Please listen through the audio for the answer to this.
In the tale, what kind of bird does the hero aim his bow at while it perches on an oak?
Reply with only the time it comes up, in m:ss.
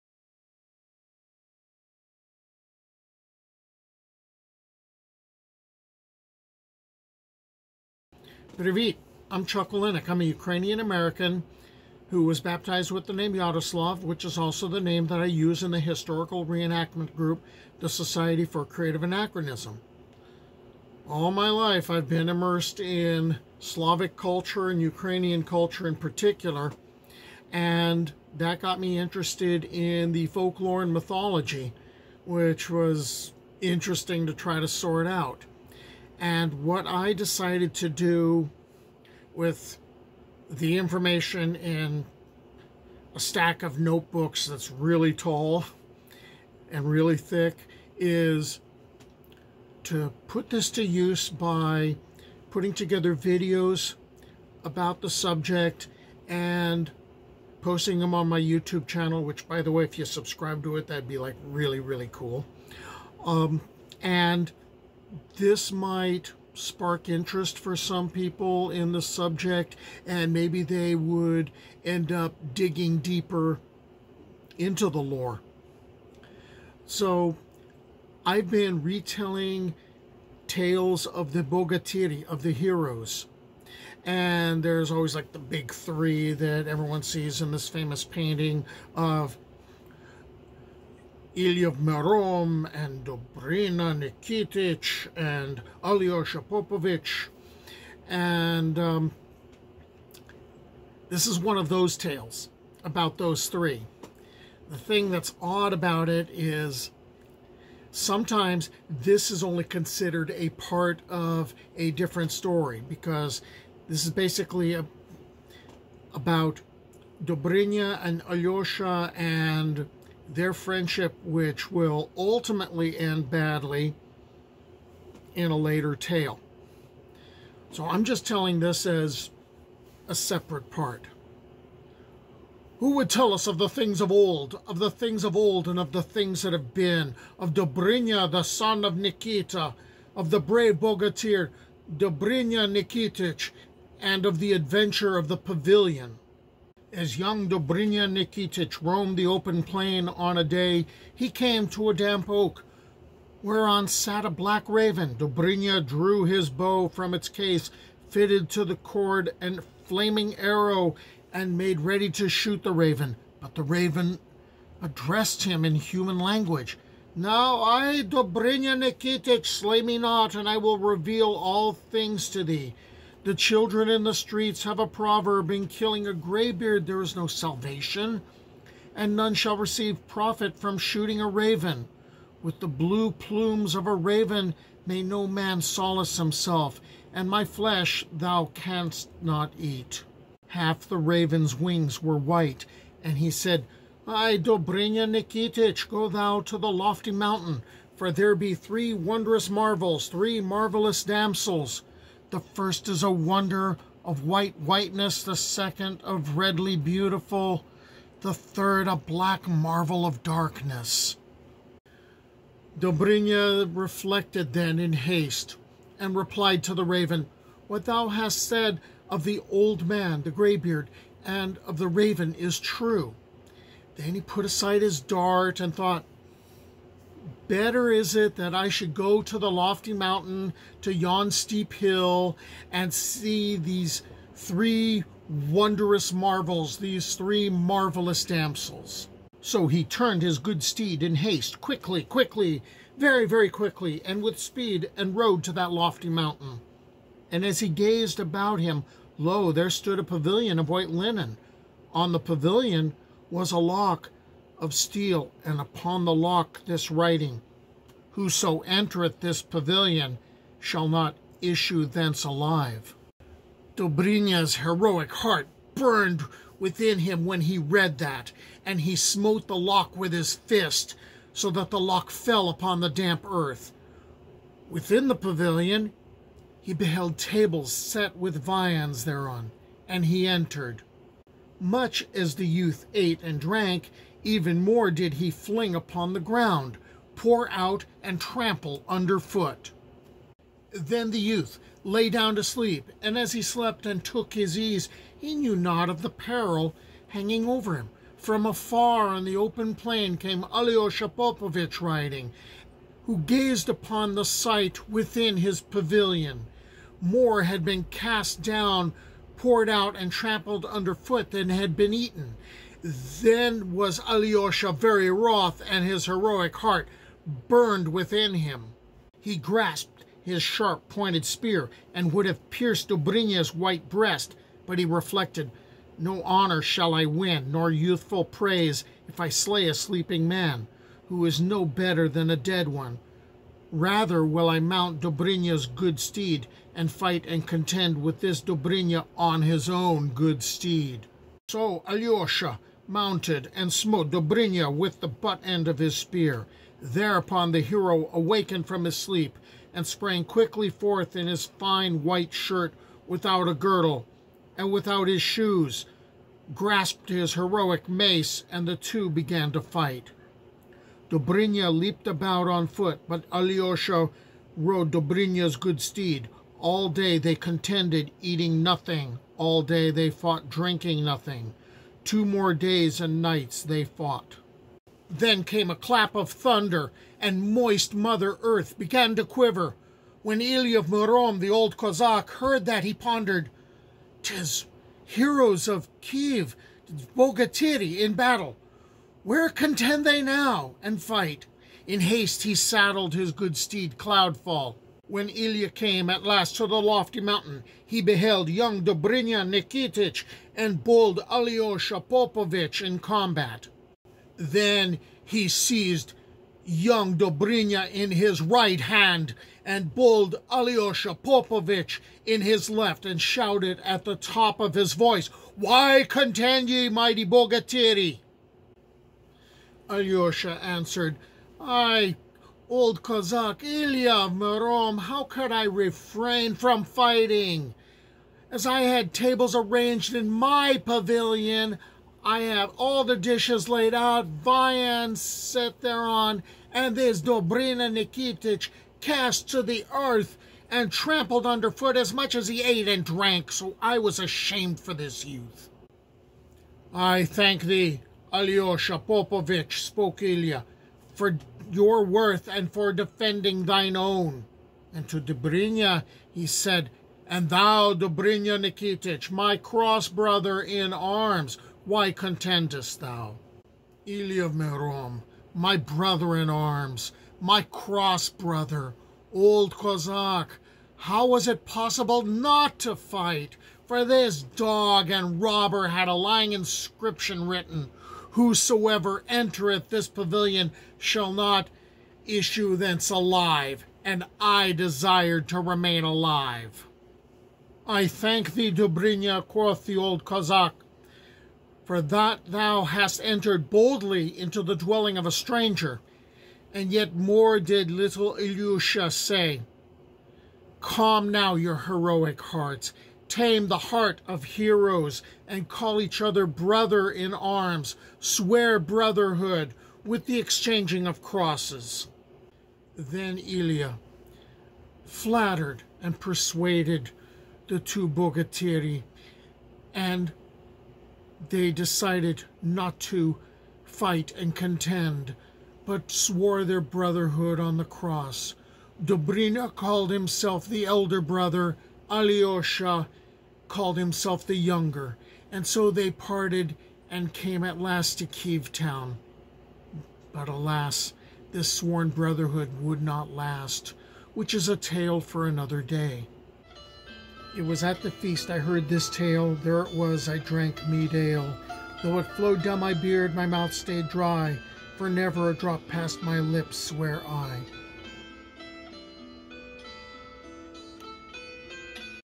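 2:34.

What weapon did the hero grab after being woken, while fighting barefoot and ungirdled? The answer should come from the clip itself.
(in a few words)
heroic mace.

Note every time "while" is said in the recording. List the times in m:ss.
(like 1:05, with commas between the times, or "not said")
not said.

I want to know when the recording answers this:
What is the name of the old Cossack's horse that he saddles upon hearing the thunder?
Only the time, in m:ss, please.
6:33.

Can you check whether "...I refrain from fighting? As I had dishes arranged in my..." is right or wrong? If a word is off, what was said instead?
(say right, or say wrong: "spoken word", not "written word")
wrong: "tables", not "dishes".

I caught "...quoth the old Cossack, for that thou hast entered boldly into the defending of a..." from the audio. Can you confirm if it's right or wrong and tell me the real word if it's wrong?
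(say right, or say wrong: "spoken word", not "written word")
wrong: "dwelling", not "defending".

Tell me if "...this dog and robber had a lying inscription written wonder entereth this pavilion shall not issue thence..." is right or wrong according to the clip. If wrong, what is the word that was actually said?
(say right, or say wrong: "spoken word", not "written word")
wrong: "whosoever", not "wonder".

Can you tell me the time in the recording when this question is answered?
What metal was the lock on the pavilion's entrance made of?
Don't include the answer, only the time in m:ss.
4:14.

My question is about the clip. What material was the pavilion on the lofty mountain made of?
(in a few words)
white linen.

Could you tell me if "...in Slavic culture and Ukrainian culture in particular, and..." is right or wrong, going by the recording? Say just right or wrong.
right.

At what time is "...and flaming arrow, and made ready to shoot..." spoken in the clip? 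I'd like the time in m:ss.
2:39.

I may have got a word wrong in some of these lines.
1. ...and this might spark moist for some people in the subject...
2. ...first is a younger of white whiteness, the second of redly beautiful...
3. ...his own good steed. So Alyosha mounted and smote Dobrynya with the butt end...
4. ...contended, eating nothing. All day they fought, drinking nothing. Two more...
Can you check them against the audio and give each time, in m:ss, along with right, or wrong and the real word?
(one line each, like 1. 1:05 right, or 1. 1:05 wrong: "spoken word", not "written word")
1. 1:04 wrong: "interest", not "moist"
2. 3:22 wrong: "wonder", not "younger"
3. 5:39 right
4. 6:07 right.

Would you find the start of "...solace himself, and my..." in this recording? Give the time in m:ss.
3:05.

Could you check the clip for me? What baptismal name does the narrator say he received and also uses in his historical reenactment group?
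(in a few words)
Yaroslav.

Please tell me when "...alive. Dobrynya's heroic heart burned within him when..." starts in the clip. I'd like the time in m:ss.
4:22.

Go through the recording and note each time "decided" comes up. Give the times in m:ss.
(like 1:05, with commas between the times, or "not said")
0:37, 8:41.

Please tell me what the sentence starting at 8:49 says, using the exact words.
Dobrynya called himself the elder brother, Alyosha called himself the younger, and so they parted and came at last to Kiev town.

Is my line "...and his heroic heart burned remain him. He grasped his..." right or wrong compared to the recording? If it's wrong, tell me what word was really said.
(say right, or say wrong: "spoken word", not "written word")
wrong: "within", not "remain".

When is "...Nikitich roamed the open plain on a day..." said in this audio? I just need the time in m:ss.
2:28.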